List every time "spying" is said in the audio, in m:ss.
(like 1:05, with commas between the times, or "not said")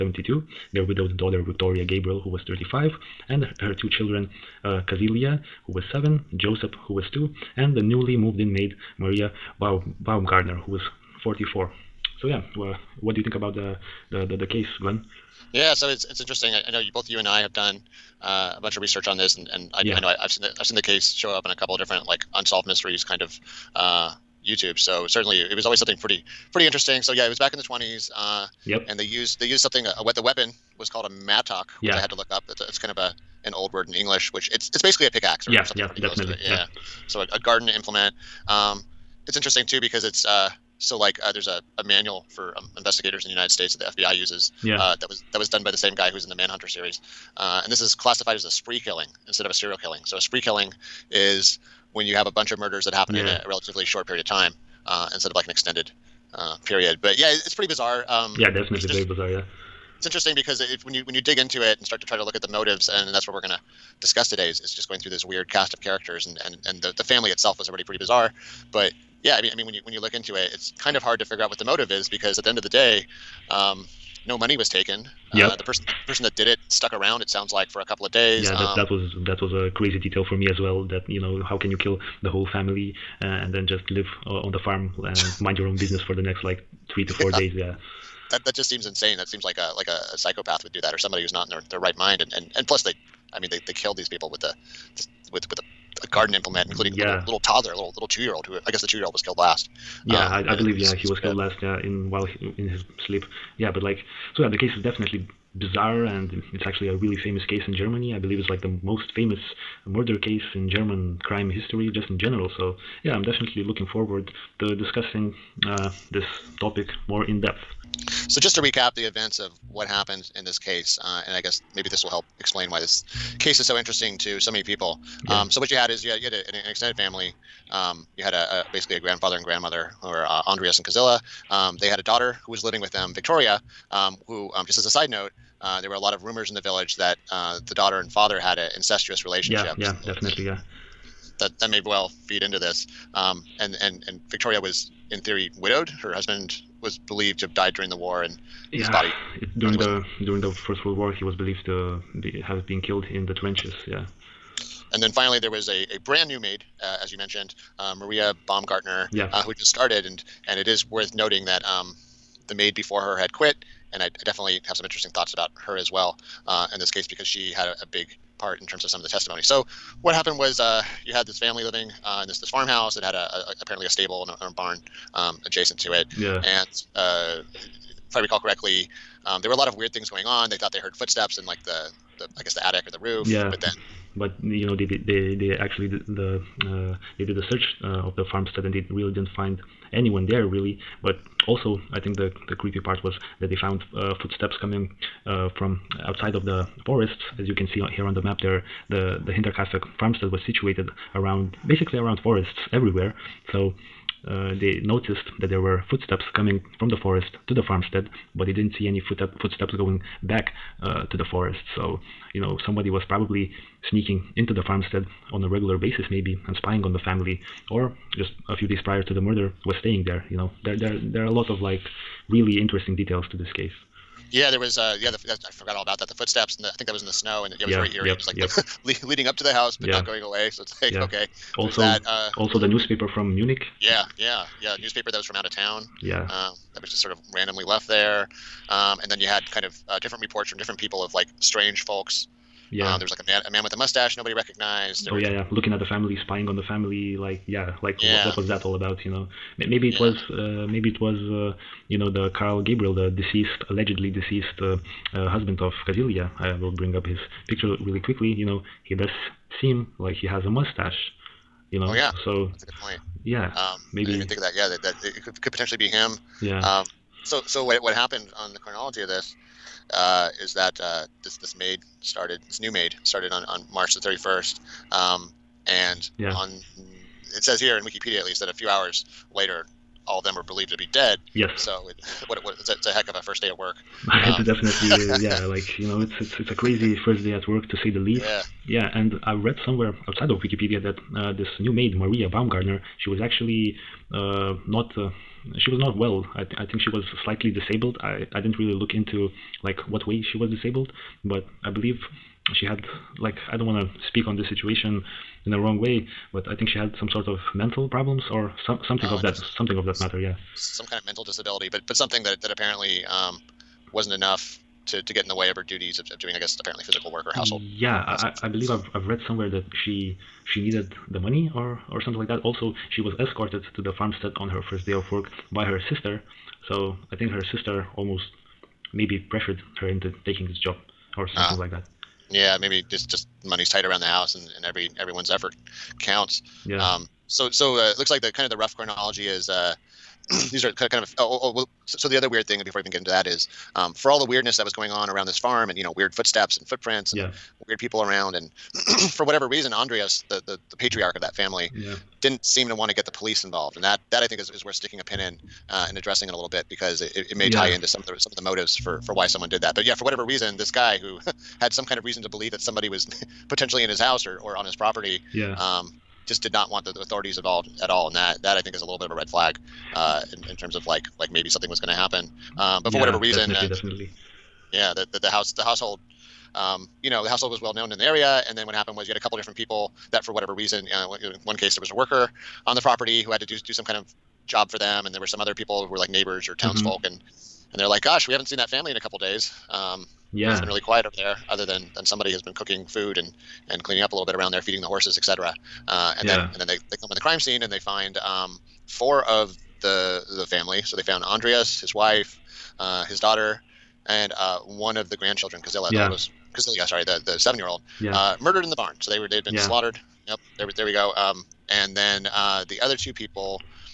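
3:36, 4:06.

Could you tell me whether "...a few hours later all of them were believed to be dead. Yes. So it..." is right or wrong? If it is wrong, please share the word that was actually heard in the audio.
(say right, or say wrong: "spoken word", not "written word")
right.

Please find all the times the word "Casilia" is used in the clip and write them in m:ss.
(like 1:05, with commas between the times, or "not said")
0:04, 4:15, 6:46.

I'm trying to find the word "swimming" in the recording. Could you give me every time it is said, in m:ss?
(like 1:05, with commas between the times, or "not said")
not said.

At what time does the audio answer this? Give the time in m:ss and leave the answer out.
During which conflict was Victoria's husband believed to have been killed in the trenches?
2:30.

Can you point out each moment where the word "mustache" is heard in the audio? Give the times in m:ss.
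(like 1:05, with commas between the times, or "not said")
4:03, 4:20.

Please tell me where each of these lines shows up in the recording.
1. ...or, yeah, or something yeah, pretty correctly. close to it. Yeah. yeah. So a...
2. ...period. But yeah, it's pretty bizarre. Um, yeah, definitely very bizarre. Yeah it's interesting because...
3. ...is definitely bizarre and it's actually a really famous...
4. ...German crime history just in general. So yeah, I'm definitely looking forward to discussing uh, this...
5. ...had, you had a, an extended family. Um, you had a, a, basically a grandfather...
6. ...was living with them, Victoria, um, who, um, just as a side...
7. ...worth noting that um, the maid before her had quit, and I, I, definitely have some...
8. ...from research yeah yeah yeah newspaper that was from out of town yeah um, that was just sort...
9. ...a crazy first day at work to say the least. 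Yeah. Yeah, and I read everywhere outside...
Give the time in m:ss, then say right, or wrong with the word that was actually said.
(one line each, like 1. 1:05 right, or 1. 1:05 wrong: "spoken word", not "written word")
1. 0:35 wrong: "definitely", not "correctly"
2. 0:56 right
3. 1:44 right
4. 1:50 right
5. 2:06 right
6. 2:12 right
7. 2:40 right
8. 3:53 wrong: "munich", not "research"
9. 4:46 wrong: "somewhere", not "everywhere".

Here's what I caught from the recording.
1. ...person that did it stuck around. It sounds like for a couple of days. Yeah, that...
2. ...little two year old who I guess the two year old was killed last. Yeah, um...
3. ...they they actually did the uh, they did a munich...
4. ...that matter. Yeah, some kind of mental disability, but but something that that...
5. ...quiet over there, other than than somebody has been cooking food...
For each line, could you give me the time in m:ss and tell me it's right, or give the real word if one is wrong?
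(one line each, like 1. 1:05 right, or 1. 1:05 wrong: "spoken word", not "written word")
1. 1:16 right
2. 1:37 right
3. 3:04 wrong: "search", not "munich"
4. 5:09 right
5. 6:30 right.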